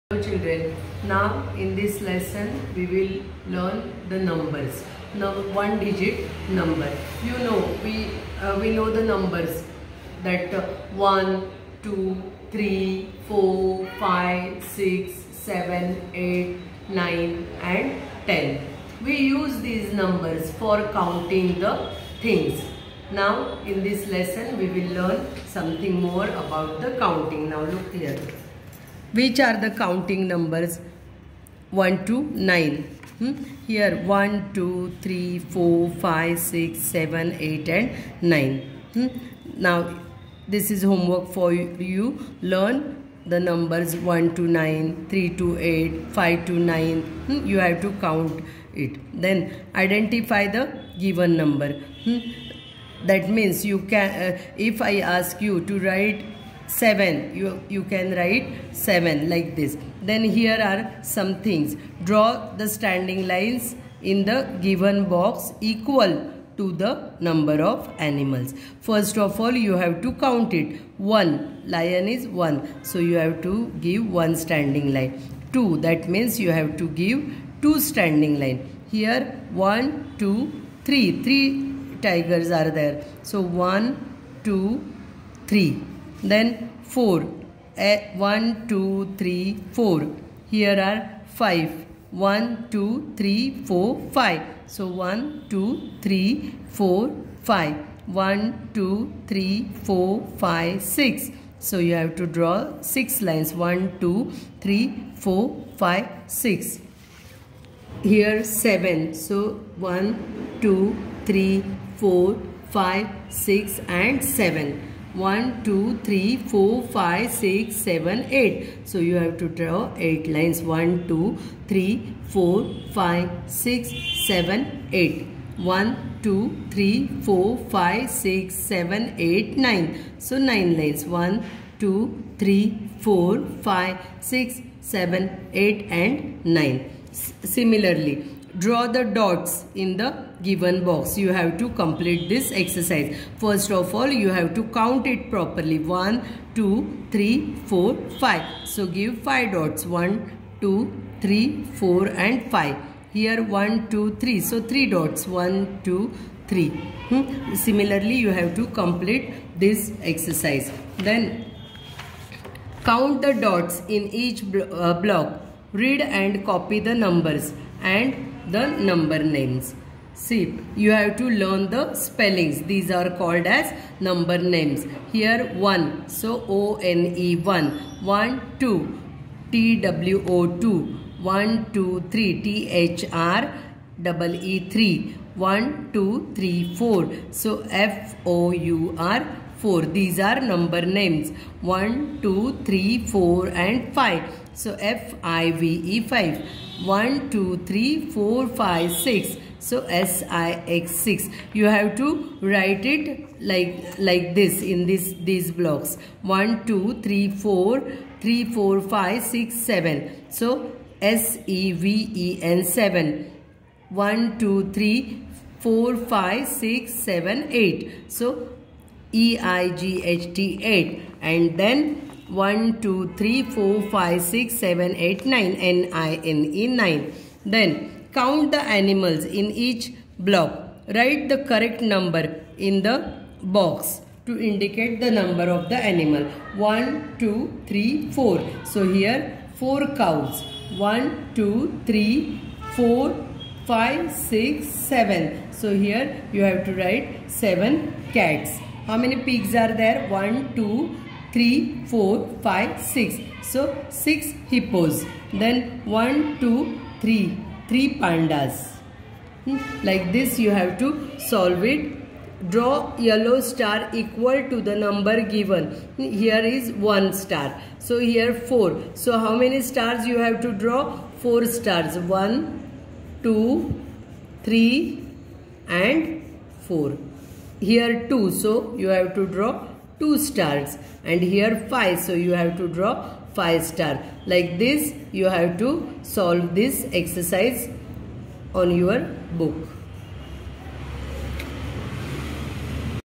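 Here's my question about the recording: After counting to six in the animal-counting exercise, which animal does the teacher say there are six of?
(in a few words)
hippos.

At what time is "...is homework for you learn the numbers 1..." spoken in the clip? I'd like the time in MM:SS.
00:40.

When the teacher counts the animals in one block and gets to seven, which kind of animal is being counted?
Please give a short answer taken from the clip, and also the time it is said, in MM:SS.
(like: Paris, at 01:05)
cats, at 04:07.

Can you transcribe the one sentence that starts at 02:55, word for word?
Here 1, so O-N-E 1, 1, 2, T-W-O-2, 1, 2, 3, T-H-R, double E 3, 1, 2, 3, 4.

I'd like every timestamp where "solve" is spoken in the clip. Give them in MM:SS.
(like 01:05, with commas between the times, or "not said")
04:21, 04:46.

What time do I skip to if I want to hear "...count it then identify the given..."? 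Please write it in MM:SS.
00:47.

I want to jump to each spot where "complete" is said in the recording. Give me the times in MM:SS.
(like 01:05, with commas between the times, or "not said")
02:21, 02:38.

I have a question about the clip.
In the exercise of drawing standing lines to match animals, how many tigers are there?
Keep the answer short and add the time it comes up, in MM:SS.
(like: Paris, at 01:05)
3, at 01:21.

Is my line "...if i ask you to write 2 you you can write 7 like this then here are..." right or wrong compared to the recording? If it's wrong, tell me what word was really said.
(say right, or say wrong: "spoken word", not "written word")
wrong: "7", not "2".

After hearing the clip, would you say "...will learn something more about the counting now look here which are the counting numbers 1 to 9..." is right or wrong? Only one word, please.
right.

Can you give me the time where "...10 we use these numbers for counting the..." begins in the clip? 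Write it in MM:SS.
00:18.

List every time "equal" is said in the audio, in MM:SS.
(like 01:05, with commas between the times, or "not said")
01:05, 04:23.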